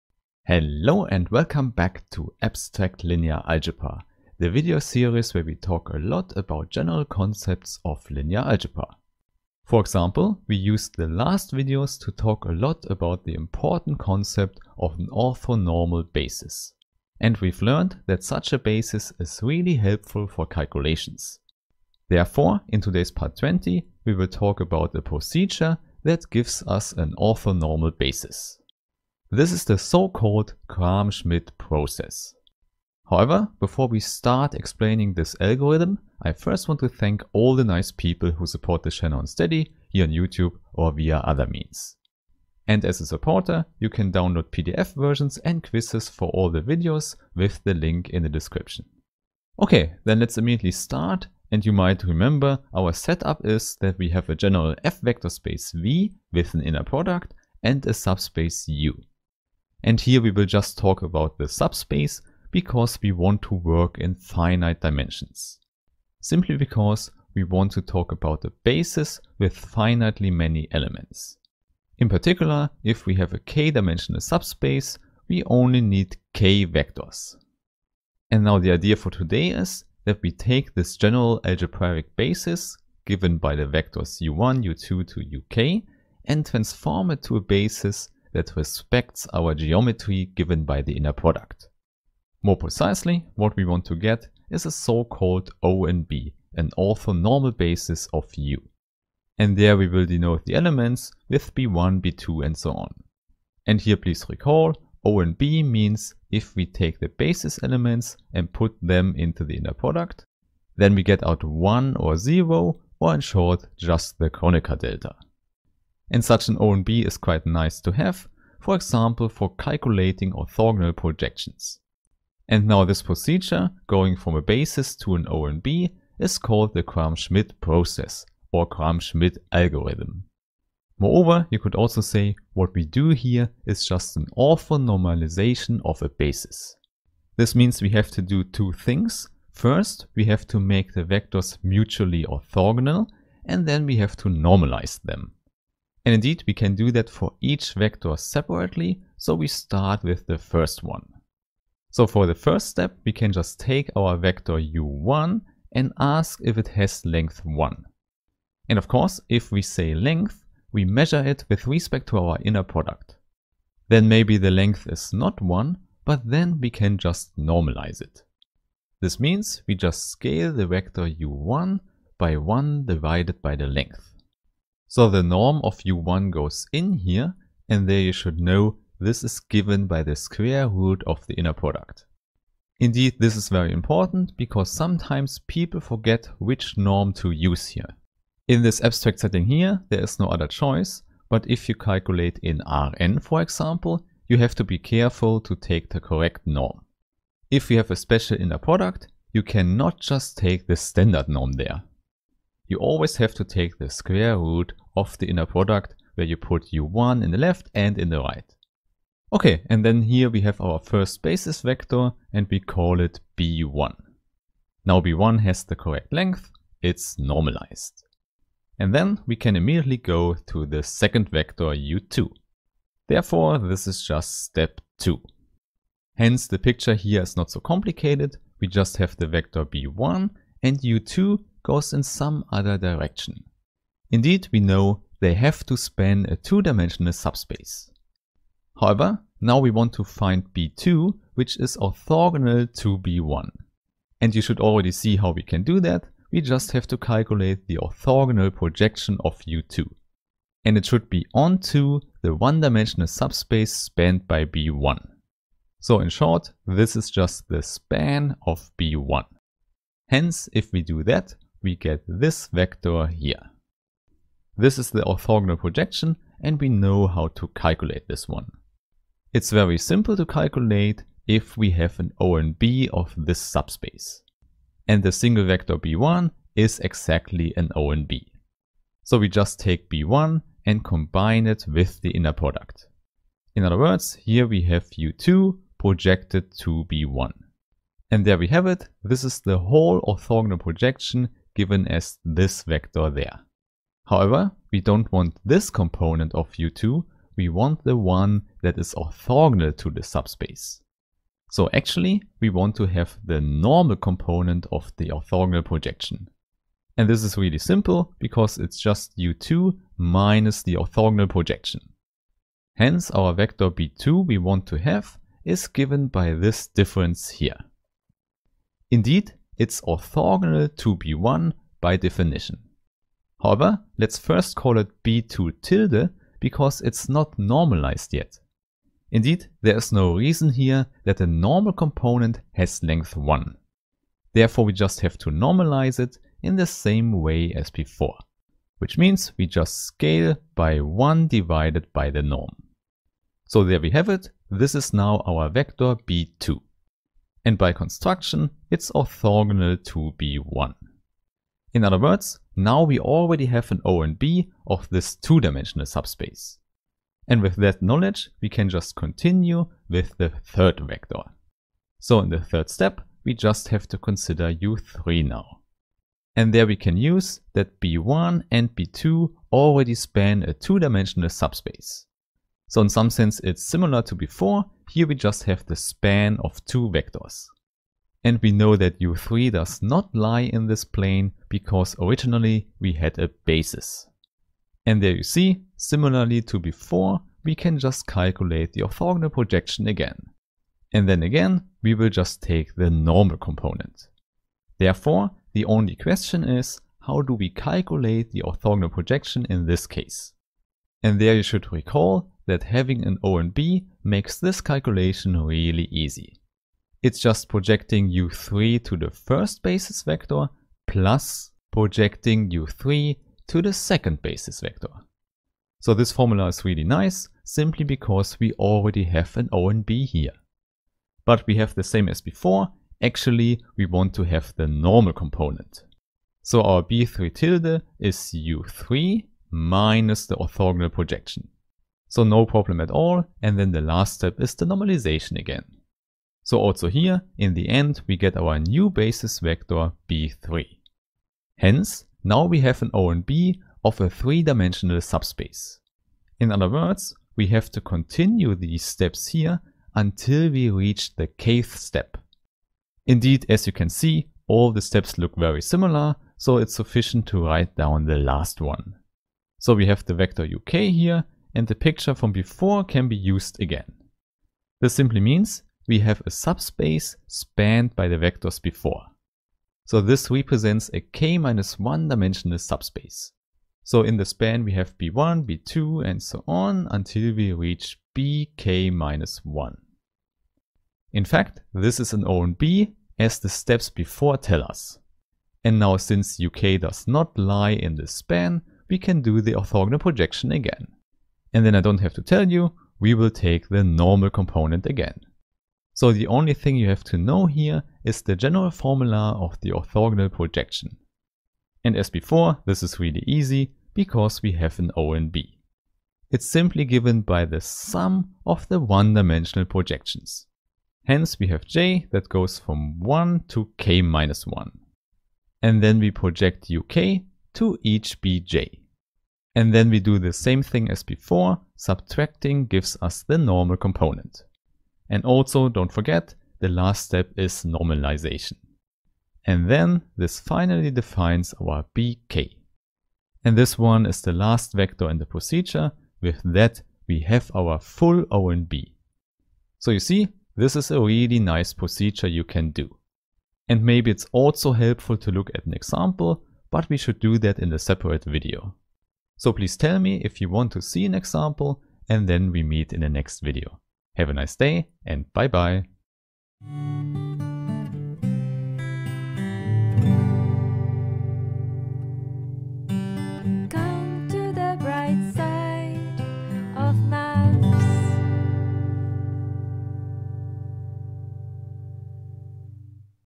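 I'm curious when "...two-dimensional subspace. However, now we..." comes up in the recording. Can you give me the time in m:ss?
3:56.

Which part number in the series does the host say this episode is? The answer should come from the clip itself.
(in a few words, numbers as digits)
20.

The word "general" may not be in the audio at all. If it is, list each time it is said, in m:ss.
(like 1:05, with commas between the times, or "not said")
0:06, 0:54, 1:20, 8:18.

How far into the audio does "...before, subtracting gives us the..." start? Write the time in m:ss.
8:41.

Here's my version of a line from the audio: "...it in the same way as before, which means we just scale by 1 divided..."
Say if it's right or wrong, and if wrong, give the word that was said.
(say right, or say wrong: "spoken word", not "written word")
right.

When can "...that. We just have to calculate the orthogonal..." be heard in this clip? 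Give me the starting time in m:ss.
4:05.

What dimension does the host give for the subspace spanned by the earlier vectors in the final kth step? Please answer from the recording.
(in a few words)
k minus 1.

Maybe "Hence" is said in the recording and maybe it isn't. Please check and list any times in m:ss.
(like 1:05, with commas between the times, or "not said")
3:46, 4:20, 5:12, 7:21, 8:31.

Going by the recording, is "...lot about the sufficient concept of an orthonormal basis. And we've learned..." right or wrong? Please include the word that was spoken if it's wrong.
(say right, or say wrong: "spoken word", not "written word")
wrong: "important", not "sufficient".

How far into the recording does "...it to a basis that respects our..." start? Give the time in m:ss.
1:27.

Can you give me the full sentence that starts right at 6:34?
Therefore, the only question is, how do we calculate the orthogonal projection in this case?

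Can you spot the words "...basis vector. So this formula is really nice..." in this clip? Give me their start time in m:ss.
6:54.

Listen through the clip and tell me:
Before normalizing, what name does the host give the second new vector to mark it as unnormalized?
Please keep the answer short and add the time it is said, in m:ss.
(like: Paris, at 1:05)
b2 tilde, at 5:25.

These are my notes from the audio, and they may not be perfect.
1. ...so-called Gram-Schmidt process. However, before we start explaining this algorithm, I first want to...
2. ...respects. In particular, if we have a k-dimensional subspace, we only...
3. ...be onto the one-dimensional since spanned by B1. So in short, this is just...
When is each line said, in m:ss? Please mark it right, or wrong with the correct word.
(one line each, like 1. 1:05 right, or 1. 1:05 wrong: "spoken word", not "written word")
1. 0:29 right
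2. 1:10 wrong: "elements", not "respects"
3. 4:11 wrong: "subspace", not "since".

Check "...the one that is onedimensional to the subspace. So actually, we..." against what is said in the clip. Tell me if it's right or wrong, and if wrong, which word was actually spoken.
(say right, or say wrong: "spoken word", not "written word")
wrong: "orthogonal", not "onedimensional".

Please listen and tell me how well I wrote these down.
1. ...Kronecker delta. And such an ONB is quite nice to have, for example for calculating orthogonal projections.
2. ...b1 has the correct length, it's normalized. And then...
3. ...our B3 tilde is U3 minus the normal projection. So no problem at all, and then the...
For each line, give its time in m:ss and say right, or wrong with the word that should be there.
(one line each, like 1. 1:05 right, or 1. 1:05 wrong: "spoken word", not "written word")
1. 1:54 right
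2. 3:34 right
3. 7:06 wrong: "orthogonal", not "normal".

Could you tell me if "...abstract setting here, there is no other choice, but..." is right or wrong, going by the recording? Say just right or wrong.
right.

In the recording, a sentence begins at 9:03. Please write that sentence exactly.
And maybe it's also helpful to look at an example, but we should do that in a separate video.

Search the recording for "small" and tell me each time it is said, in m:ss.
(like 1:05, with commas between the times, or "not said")
not said.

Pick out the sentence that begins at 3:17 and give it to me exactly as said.
If you have a special inner product, you cannot just take the standard norm there.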